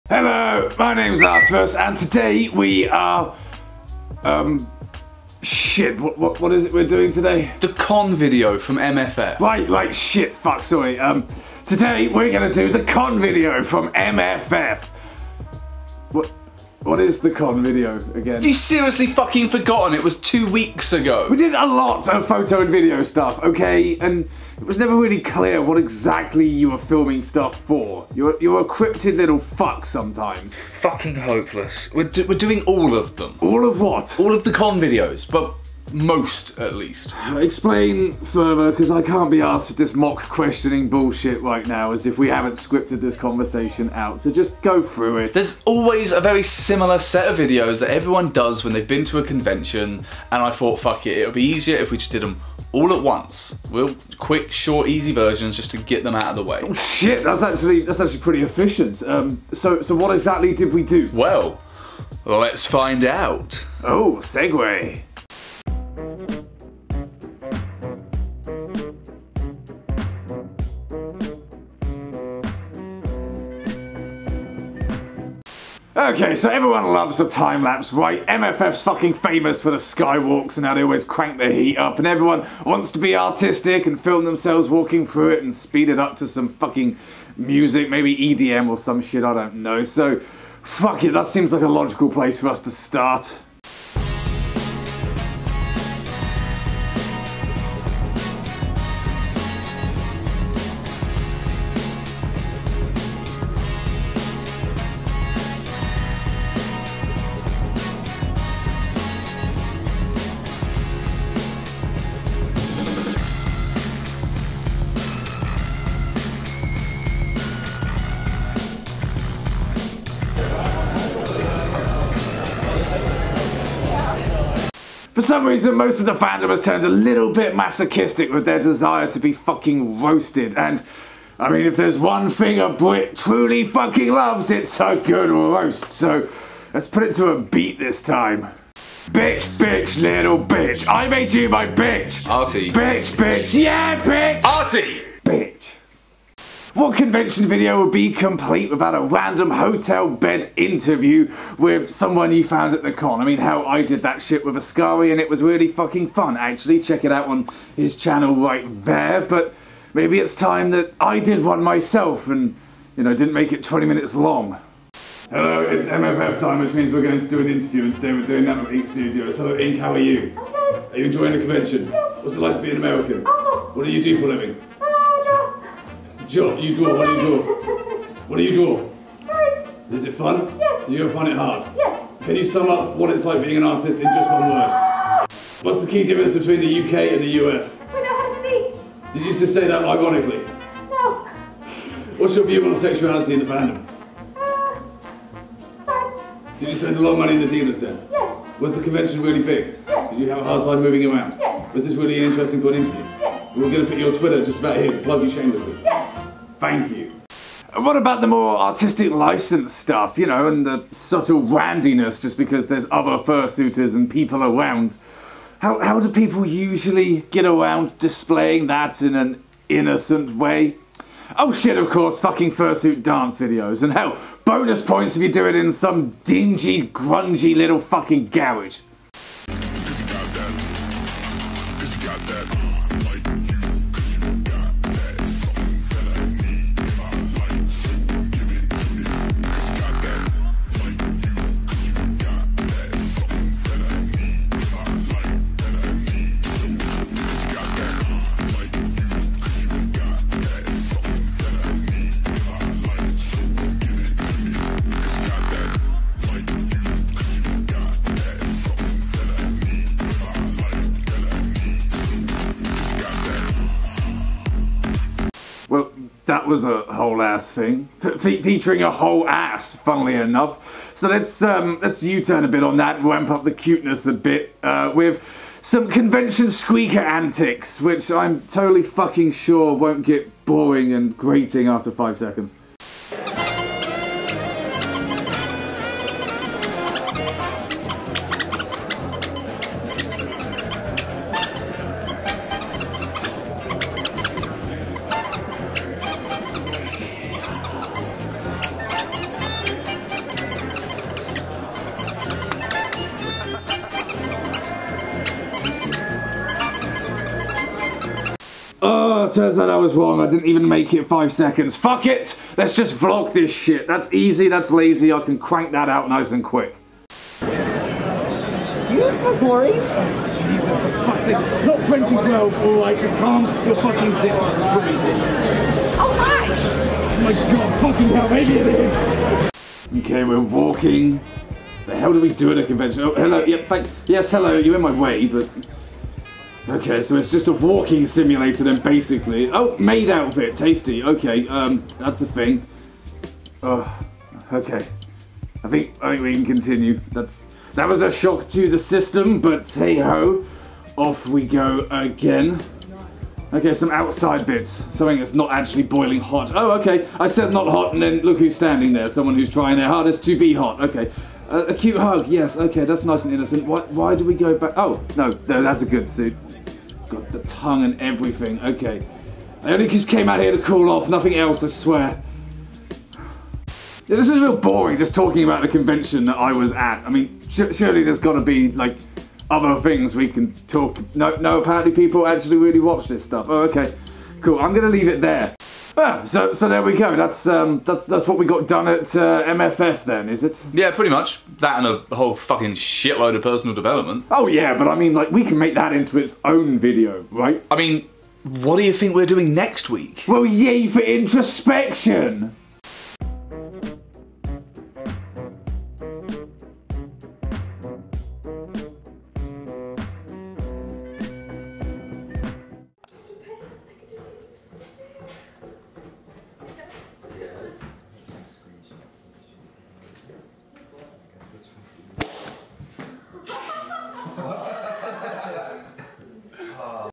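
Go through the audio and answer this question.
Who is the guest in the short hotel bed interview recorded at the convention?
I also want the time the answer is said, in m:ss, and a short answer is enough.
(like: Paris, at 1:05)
Ink Studios, at 2:48.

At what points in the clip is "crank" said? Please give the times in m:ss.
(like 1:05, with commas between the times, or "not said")
1:21, 5:15.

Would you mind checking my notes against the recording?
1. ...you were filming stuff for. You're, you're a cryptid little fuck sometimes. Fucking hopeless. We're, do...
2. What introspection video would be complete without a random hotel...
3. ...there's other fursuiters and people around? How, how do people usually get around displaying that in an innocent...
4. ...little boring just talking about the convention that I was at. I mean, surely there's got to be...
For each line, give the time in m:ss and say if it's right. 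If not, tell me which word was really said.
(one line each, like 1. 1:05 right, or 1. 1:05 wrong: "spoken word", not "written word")
1. 0:26 right
2. 2:26 wrong: "convention", not "introspection"
3. 3:32 right
4. 6:14 right.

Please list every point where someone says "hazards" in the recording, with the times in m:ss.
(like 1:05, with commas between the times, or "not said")
not said.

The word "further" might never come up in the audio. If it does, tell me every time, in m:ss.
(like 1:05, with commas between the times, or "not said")
0:38.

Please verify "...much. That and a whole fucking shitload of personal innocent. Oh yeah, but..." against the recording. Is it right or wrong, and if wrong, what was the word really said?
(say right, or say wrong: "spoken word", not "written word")
wrong: "development", not "innocent".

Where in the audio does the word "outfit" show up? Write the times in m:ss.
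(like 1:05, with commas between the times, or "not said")
5:40.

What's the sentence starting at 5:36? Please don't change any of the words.
Okay, so it's just a walking simulator then, basically.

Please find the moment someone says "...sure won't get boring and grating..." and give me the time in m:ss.
4:39.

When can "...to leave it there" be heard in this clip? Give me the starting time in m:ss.
6:24.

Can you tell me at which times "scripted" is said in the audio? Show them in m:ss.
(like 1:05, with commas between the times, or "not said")
0:42.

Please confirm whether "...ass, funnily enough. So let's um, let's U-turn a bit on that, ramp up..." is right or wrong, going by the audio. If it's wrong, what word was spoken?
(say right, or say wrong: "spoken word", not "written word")
right.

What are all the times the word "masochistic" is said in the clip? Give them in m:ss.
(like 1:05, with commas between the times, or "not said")
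2:07.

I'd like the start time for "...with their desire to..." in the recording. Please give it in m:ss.
2:08.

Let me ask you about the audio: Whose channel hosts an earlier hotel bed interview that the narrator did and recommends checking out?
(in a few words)
Ascari.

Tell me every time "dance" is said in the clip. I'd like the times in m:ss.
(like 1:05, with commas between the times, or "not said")
3:43.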